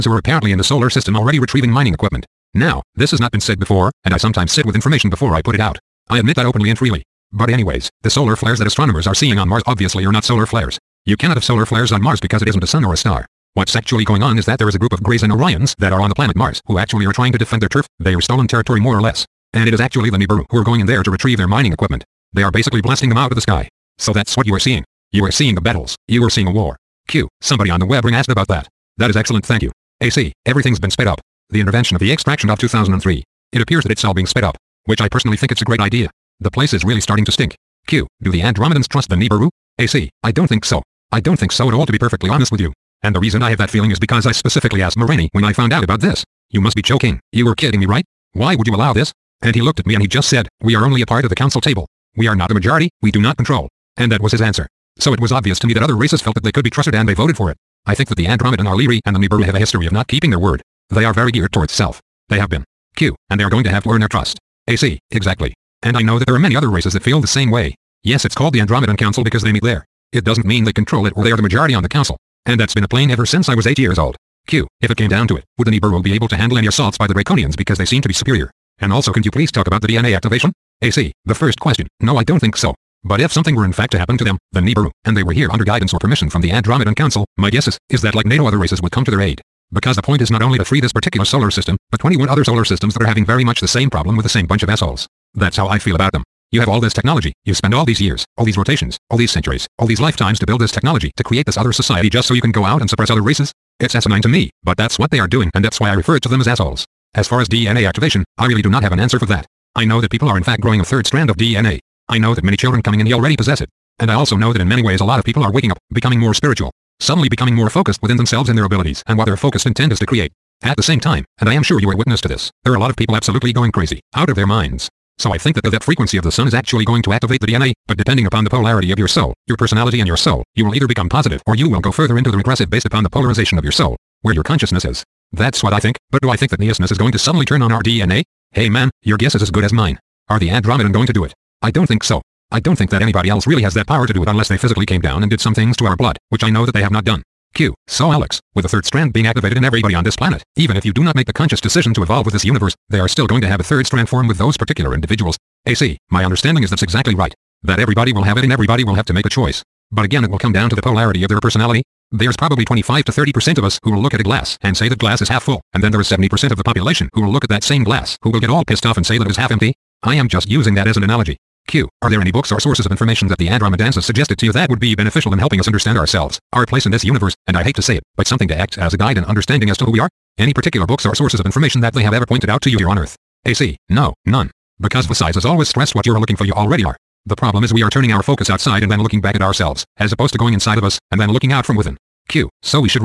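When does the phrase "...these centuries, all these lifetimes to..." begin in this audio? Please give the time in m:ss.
1:39.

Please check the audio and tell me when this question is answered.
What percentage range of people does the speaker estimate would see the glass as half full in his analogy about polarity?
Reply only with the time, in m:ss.
2:42.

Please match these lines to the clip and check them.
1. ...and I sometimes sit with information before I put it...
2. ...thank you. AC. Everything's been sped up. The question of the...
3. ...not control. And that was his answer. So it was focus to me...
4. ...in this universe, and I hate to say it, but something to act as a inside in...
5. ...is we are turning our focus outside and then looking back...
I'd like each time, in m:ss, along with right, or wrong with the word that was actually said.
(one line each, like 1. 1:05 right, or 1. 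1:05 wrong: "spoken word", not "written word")
1. 0:04 right
2. 0:29 wrong: "intervention", not "question"
3. 0:53 wrong: "obvious", not "focus"
4. 2:56 wrong: "guide", not "inside"
5. 3:07 right.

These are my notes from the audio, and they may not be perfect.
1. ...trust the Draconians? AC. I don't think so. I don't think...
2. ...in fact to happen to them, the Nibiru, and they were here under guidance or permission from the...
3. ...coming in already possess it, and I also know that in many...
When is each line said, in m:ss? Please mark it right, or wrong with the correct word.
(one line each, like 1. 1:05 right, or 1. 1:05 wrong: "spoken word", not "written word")
1. 0:38 wrong: "Nibiru", not "Draconians"
2. 1:23 right
3. 1:52 right.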